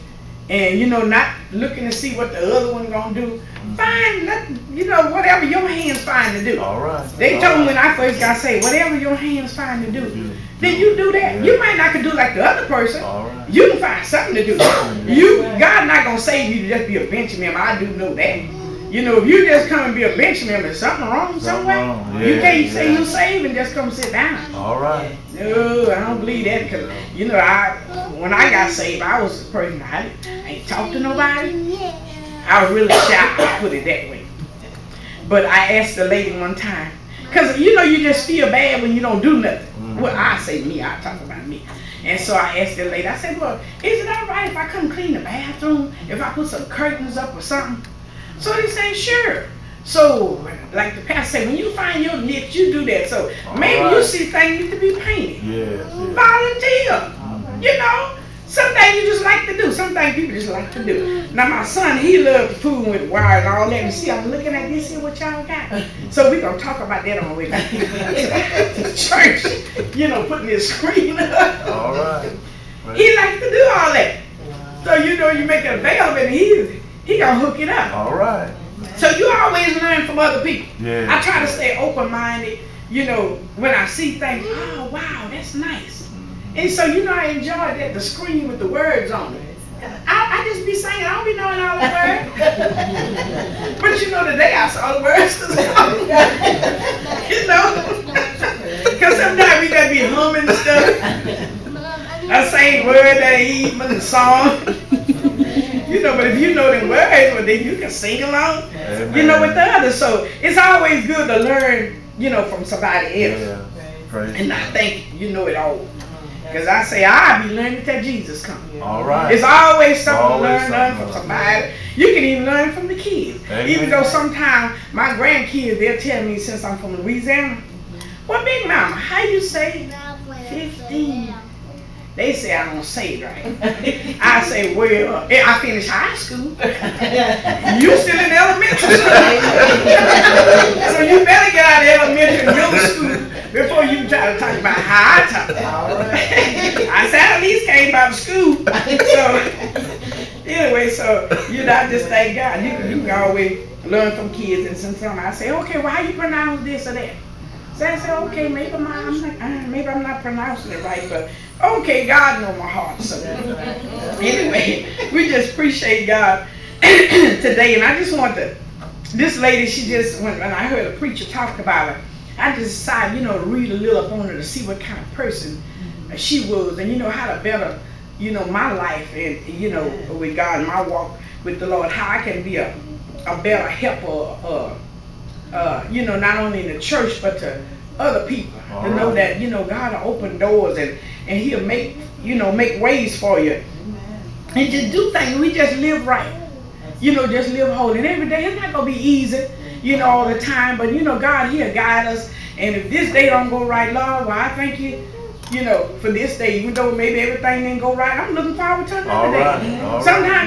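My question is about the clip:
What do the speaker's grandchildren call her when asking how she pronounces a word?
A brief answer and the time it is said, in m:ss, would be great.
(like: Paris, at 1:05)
Big Mama, at 2:08.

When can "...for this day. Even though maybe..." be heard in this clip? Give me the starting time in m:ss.
3:26.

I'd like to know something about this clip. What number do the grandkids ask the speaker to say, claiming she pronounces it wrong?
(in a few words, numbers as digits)
15.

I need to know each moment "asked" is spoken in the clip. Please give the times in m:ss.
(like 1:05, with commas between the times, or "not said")
0:35, 0:42.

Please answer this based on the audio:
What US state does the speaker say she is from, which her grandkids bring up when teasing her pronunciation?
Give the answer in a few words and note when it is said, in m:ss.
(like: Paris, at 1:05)
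Louisiana, at 2:07.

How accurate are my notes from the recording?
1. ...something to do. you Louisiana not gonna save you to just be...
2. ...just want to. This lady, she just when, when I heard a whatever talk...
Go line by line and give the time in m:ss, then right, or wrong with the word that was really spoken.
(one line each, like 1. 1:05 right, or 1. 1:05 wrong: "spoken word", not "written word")
1. 0:14 wrong: "God", not "Louisiana"
2. 2:47 wrong: "preacher", not "whatever".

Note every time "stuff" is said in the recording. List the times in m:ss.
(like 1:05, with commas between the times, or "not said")
1:40.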